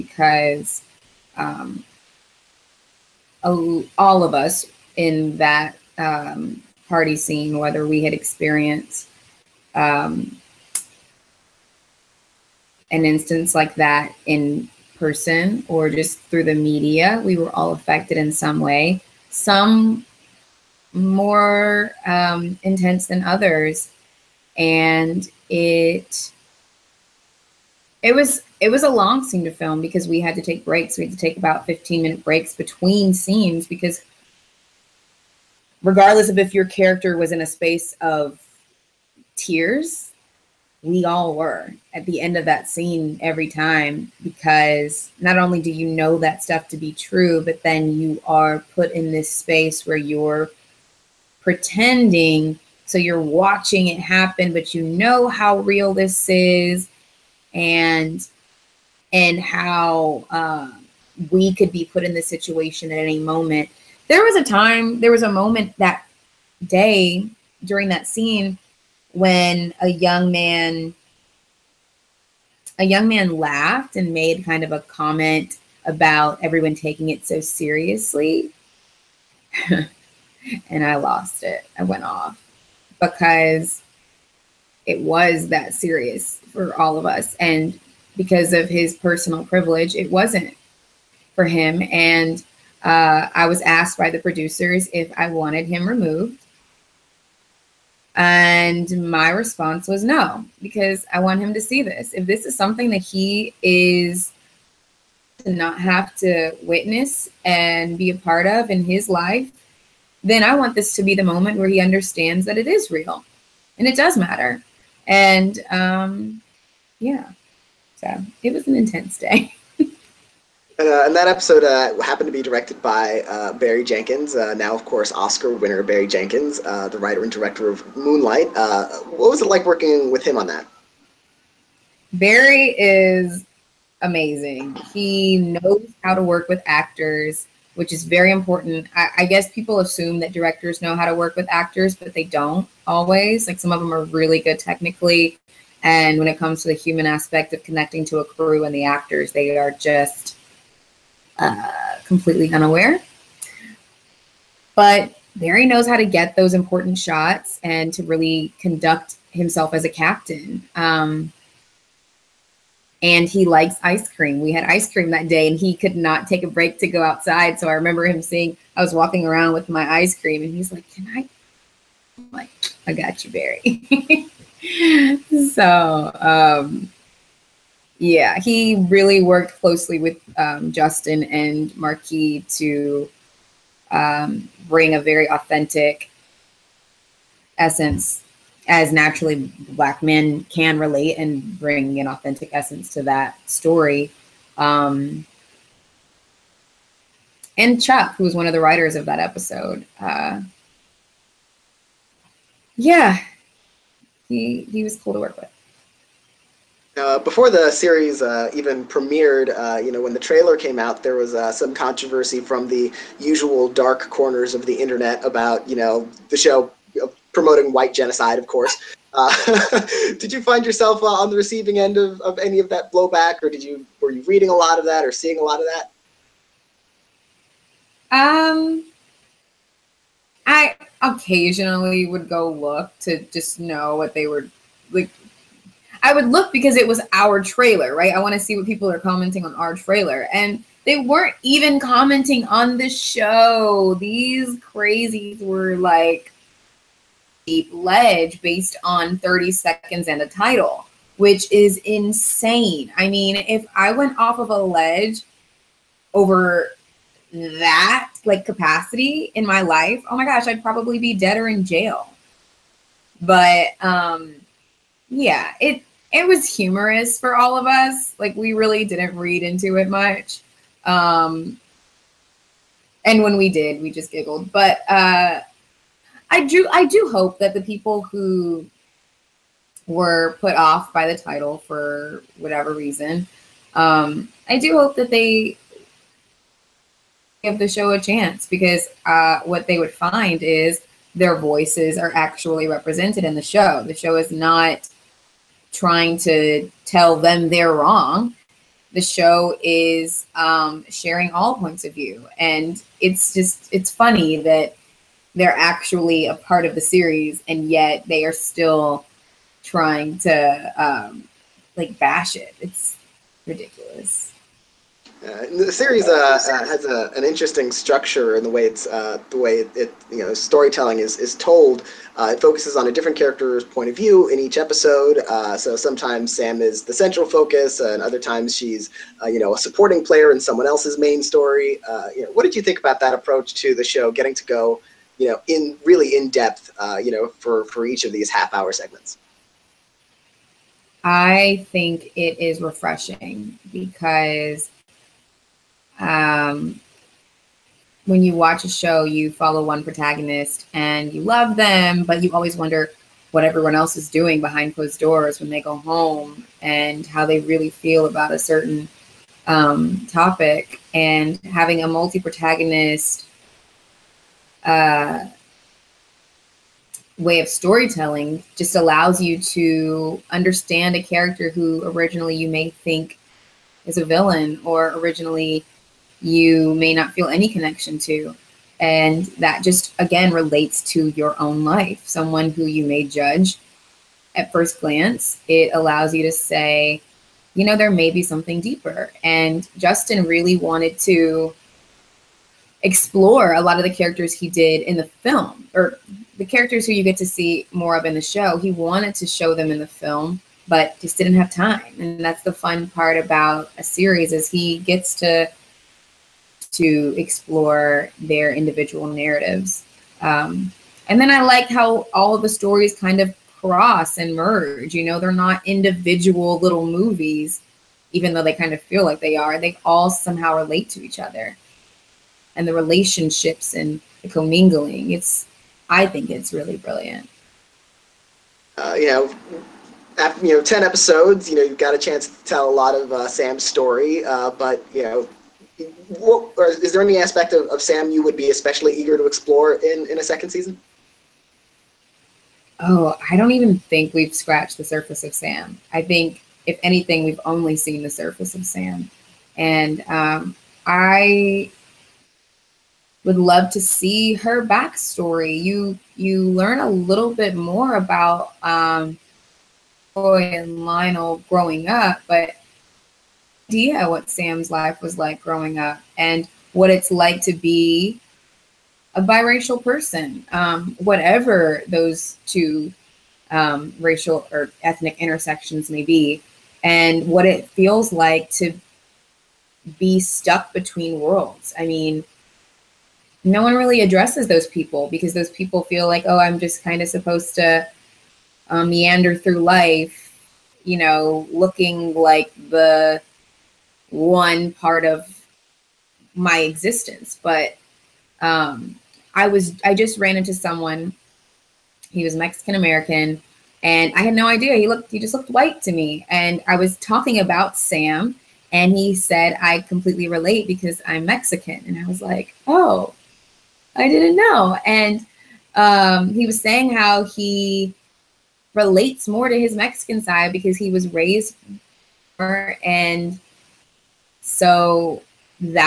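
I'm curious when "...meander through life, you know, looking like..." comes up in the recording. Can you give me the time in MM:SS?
08:08.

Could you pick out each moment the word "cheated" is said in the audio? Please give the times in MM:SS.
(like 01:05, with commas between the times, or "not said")
not said.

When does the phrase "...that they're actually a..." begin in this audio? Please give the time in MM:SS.
05:04.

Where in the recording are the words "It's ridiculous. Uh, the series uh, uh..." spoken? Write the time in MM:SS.
05:12.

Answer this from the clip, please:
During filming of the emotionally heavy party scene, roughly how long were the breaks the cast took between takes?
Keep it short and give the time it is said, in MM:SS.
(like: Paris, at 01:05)
15 minutes, at 00:31.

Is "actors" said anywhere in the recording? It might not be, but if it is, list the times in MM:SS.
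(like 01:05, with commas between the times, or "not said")
02:16, 02:21, 02:28.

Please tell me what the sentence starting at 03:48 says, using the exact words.
Um, I occasionally would go look to just know what they were like I would look because it was our trailer, right?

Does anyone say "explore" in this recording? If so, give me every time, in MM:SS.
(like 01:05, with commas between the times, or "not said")
06:32, 06:47, 07:19.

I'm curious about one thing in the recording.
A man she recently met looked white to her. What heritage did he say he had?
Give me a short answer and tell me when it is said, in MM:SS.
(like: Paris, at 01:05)
Mexican American, at 08:22.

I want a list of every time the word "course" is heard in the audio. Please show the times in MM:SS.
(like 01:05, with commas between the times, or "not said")
02:04, 03:38.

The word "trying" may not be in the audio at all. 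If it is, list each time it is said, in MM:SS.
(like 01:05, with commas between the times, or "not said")
04:55, 05:09.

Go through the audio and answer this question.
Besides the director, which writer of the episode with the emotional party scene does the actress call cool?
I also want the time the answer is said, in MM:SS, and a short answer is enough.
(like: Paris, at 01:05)
Chuck, at 03:17.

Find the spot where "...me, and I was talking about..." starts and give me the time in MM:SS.
08:25.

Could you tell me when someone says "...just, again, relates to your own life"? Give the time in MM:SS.
06:19.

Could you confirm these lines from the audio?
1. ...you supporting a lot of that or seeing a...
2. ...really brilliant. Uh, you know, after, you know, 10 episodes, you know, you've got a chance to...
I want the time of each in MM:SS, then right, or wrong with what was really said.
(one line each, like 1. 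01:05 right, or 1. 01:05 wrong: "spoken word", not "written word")
1. 03:44 wrong: "reading", not "supporting"
2. 07:06 right.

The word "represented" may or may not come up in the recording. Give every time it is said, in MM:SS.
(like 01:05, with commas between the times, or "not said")
04:52.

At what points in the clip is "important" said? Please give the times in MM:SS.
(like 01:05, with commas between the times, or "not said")
02:18, 02:36.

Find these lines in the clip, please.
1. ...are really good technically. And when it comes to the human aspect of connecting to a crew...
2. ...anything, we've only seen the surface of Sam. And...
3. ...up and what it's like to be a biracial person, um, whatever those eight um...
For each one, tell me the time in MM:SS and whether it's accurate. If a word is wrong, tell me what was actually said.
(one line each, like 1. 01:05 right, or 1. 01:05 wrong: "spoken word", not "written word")
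1. 02:23 right
2. 07:26 right
3. 07:45 wrong: "two", not "eight".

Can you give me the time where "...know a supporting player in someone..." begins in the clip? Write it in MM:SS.
05:29.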